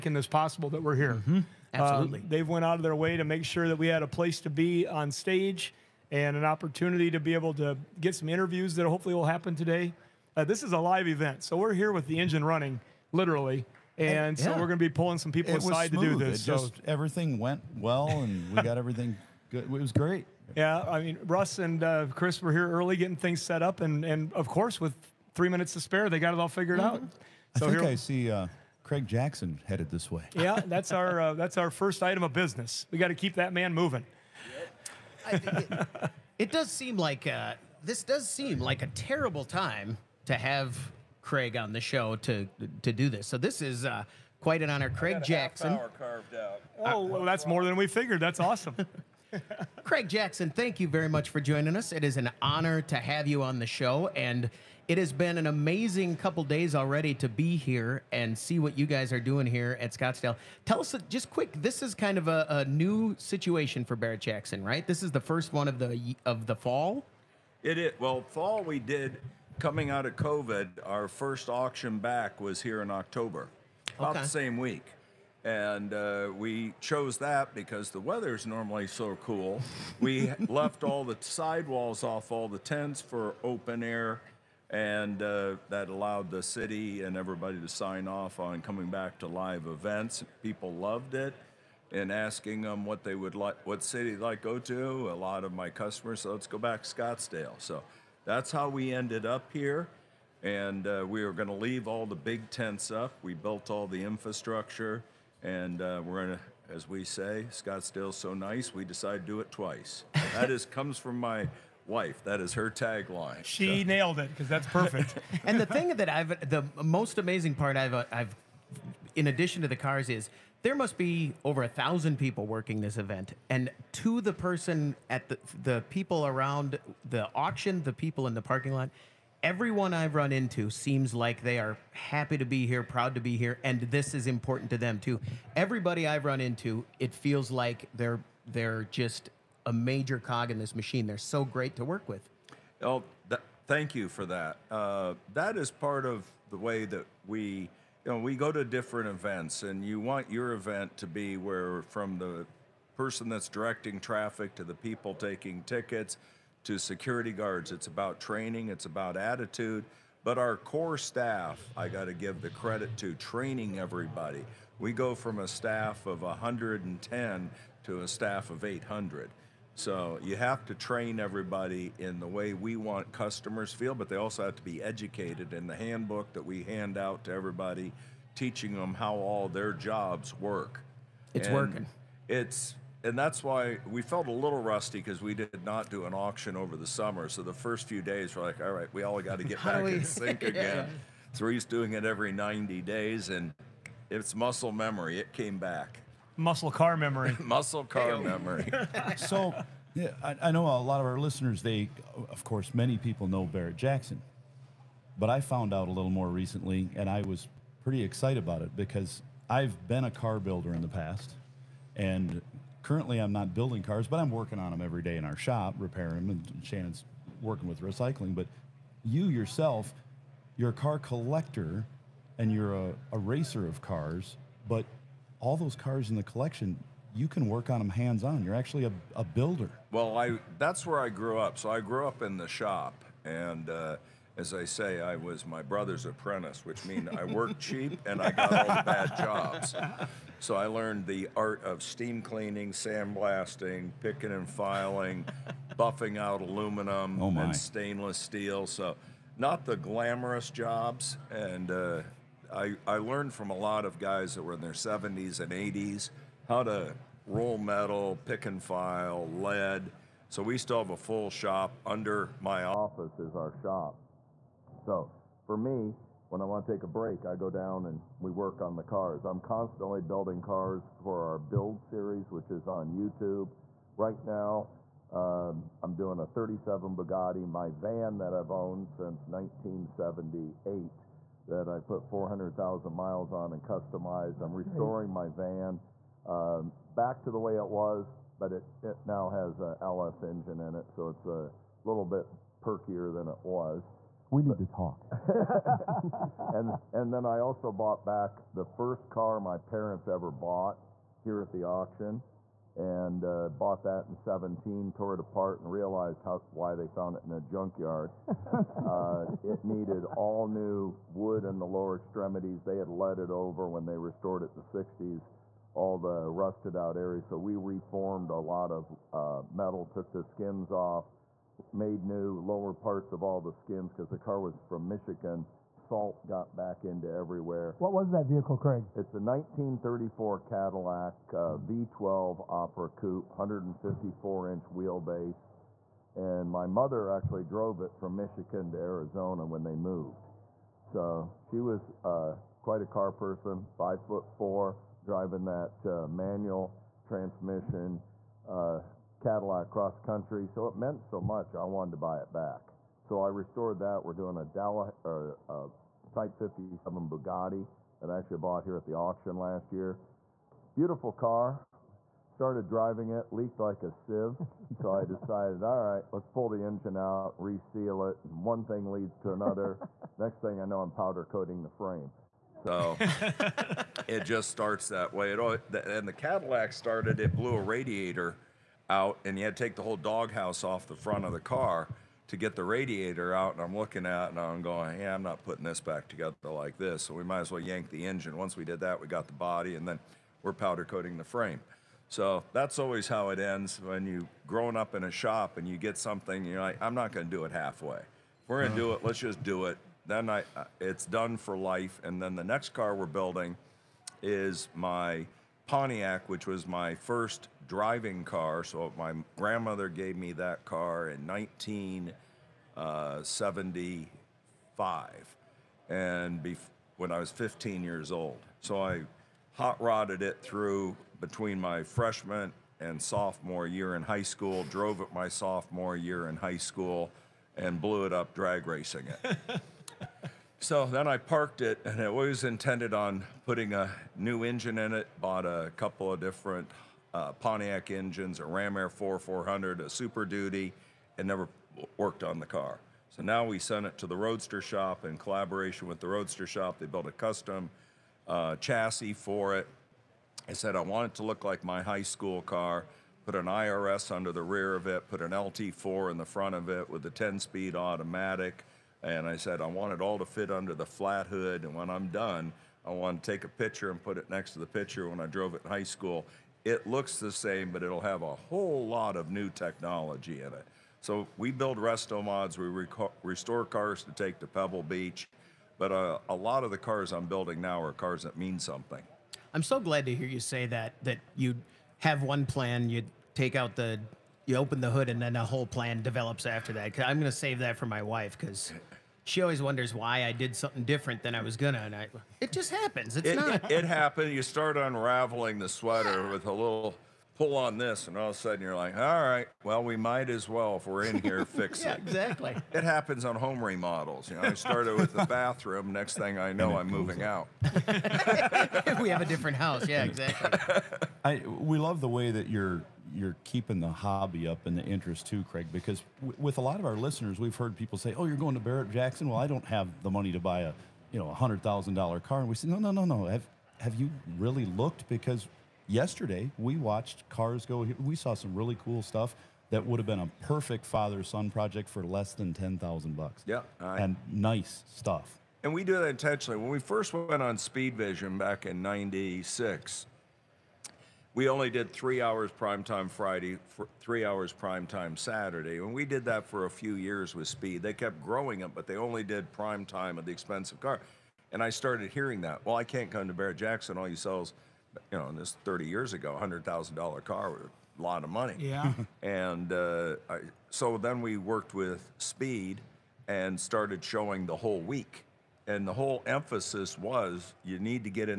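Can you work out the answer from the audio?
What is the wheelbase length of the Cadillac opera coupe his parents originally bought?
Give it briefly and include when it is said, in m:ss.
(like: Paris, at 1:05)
154 inch, at 5:33.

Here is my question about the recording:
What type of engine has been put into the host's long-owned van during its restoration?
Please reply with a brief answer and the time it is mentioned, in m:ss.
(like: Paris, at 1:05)
LS engine, at 4:49.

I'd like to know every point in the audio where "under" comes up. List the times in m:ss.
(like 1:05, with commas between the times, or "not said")
4:21, 7:34, 7:40.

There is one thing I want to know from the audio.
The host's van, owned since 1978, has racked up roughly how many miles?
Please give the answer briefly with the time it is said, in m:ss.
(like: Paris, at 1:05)
400,000, at 4:42.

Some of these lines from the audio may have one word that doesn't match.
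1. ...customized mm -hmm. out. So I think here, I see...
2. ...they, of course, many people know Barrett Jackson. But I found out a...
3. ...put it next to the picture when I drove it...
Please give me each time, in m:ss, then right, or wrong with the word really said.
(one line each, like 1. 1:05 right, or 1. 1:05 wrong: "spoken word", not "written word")
1. 0:26 wrong: "figured", not "customized"
2. 3:21 right
3. 7:44 right.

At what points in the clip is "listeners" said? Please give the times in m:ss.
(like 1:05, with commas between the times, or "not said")
3:21, 8:36.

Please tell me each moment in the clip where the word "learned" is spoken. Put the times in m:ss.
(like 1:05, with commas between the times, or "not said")
4:00, 4:12.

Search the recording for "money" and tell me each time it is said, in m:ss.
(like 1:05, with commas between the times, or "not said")
8:40, 9:18.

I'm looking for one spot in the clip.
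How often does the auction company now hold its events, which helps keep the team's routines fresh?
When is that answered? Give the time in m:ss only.
3:12.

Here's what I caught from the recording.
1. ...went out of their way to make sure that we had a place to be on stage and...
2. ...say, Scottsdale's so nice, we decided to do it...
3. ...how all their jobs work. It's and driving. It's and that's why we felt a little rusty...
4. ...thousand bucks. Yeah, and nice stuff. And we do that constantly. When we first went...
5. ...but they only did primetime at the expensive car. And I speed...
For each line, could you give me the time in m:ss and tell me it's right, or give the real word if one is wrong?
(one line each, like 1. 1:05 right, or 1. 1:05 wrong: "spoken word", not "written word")
1. 0:02 right
2. 1:47 right
3. 2:58 wrong: "working", not "driving"
4. 8:52 wrong: "intentionally", not "constantly"
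5. 9:08 wrong: "started", not "speed".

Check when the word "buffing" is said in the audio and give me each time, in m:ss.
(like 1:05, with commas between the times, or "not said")
4:05.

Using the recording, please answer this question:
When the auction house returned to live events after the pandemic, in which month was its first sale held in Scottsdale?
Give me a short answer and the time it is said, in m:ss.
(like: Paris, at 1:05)
October, at 1:12.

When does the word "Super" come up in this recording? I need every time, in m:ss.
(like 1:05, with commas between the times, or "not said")
7:19.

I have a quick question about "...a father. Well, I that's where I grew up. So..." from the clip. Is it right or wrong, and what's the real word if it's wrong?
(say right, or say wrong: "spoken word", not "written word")
wrong: "builder", not "father".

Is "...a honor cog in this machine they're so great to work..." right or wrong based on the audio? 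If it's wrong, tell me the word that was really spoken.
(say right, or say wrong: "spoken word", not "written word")
wrong: "major", not "honor".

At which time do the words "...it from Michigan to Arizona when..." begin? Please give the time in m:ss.
5:37.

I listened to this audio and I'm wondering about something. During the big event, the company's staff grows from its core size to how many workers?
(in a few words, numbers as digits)
800.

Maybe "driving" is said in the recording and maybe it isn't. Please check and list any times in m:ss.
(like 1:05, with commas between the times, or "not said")
5:45, 6:02, 6:47.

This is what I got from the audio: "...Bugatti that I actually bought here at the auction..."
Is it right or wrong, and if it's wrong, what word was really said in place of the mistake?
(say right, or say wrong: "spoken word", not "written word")
right.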